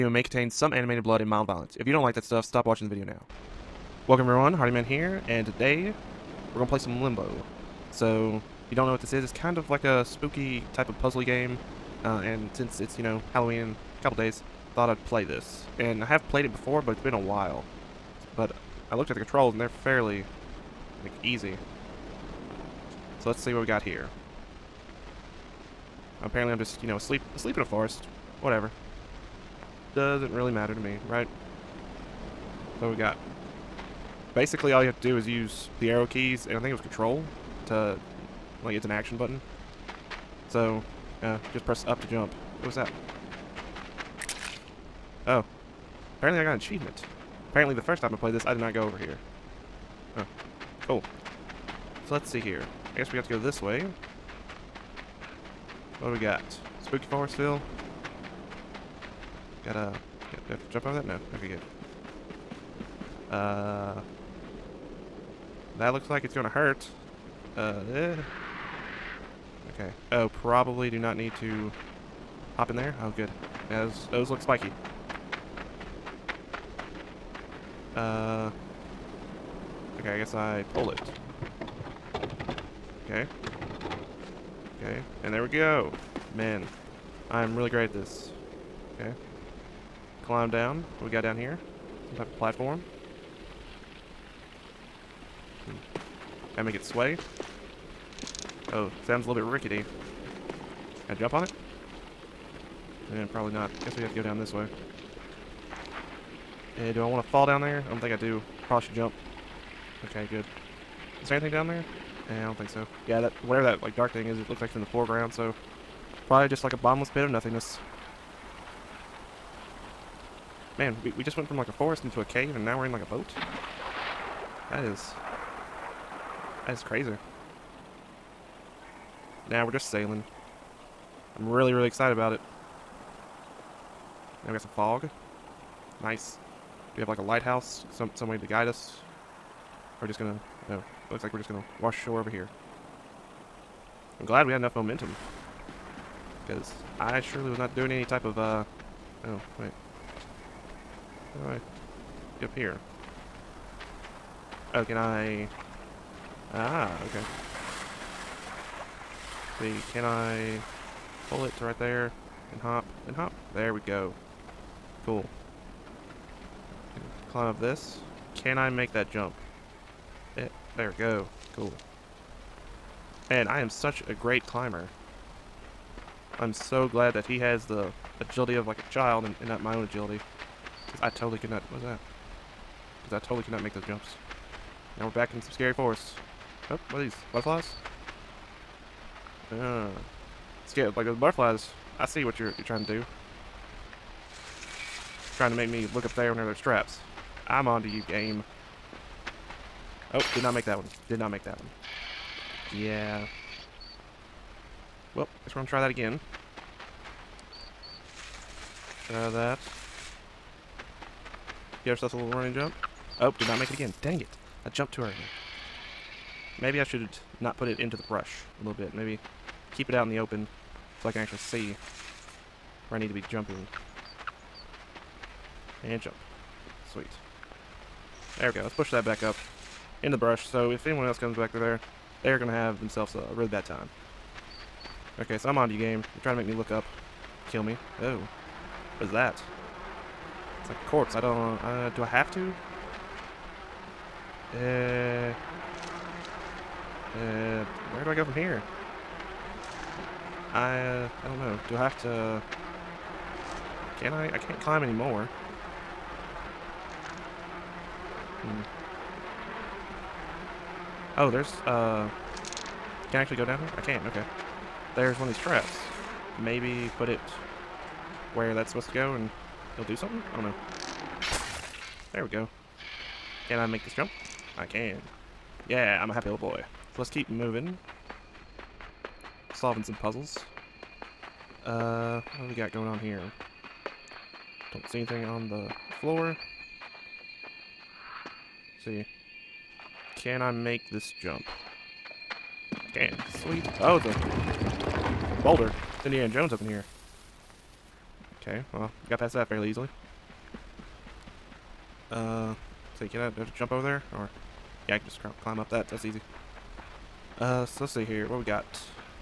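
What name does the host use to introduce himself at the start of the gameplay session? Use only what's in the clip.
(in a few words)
Hardyman.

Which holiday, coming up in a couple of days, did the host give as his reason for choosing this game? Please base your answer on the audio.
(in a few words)
Halloween.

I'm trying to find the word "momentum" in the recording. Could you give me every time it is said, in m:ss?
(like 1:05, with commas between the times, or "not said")
2:24.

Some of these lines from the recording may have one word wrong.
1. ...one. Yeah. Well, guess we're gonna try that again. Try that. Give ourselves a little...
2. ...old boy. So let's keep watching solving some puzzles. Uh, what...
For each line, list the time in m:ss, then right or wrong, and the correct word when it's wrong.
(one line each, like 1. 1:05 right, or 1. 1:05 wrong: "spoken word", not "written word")
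1. 3:21 right
2. 4:36 wrong: "moving", not "watching".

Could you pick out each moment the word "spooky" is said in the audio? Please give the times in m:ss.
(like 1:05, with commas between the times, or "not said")
0:10, 0:56.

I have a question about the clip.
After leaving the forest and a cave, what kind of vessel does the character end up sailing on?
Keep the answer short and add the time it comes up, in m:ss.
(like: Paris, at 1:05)
A boat, at 2:03.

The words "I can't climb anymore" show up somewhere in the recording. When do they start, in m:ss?
4:14.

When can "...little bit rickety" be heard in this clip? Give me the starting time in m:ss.
1:39.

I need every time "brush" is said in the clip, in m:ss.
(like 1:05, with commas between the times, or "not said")
3:38, 3:50.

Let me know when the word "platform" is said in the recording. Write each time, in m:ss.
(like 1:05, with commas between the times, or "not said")
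1:32.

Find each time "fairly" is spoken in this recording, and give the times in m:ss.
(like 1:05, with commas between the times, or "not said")
0:19, 4:59.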